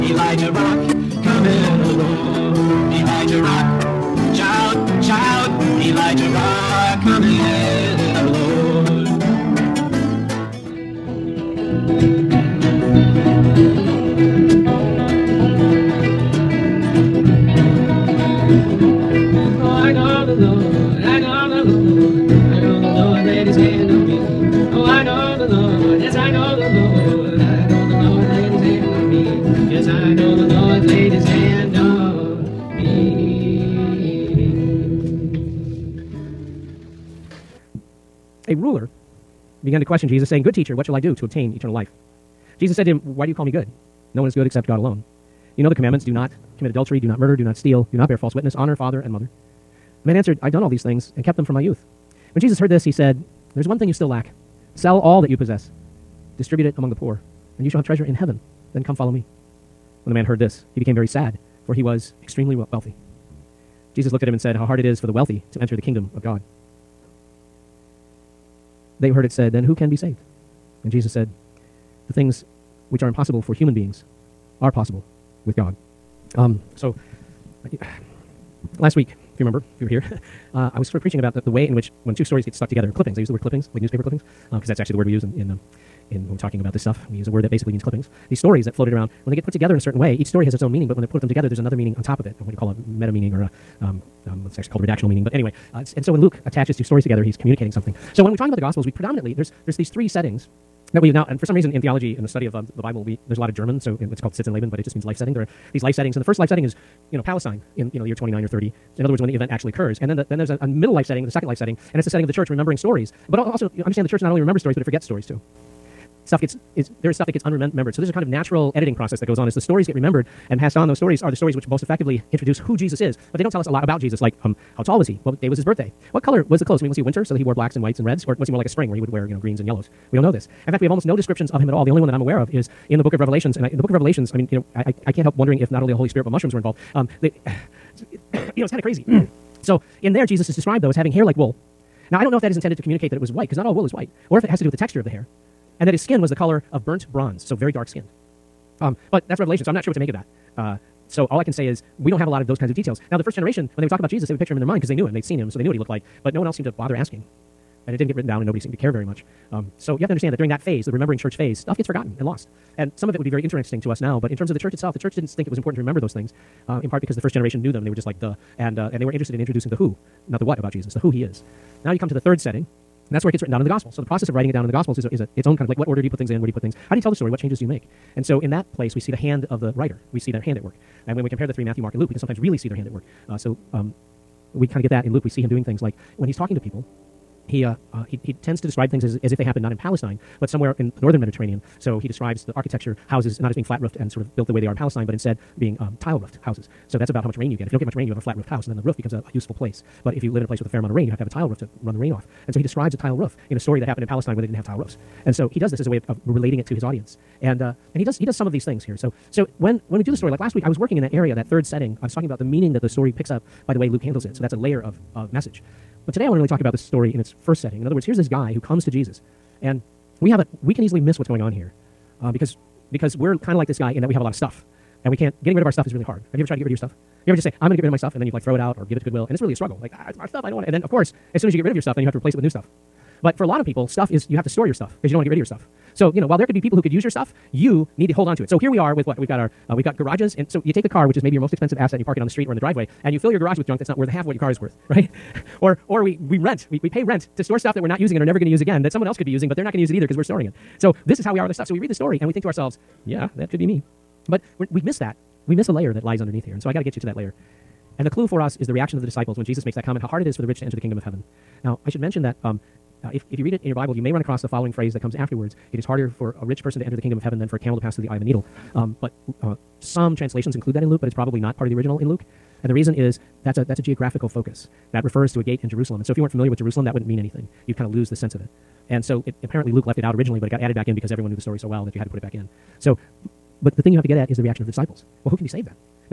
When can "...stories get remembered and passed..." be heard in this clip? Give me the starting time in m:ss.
1:59.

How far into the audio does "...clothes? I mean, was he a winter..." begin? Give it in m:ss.
2:06.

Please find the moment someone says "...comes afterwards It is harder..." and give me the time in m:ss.
4:24.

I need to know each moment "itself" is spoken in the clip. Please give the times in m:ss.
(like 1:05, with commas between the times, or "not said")
2:44.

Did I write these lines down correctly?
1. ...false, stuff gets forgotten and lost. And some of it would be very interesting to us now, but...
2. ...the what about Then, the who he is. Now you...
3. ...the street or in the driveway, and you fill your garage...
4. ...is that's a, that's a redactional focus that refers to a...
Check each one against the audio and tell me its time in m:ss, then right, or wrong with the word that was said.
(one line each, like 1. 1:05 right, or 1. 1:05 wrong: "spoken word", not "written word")
1. 2:41 wrong: "phase", not "false"
2. 2:50 wrong: "Jesus", not "Then"
3. 4:02 right
4. 4:32 wrong: "geographical", not "redactional".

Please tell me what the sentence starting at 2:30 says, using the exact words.
Uh, so all I can say is we don't have a lot of those kinds of details.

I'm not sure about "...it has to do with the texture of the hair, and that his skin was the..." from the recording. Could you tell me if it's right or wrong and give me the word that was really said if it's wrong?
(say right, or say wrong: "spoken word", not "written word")
right.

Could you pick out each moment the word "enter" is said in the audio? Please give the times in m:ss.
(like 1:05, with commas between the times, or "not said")
1:05, 4:20, 4:26.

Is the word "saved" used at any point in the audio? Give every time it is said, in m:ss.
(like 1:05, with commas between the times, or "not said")
1:09, 4:45.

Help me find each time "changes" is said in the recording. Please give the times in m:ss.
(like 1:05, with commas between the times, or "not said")
2:57.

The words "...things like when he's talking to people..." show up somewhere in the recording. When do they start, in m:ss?
3:05.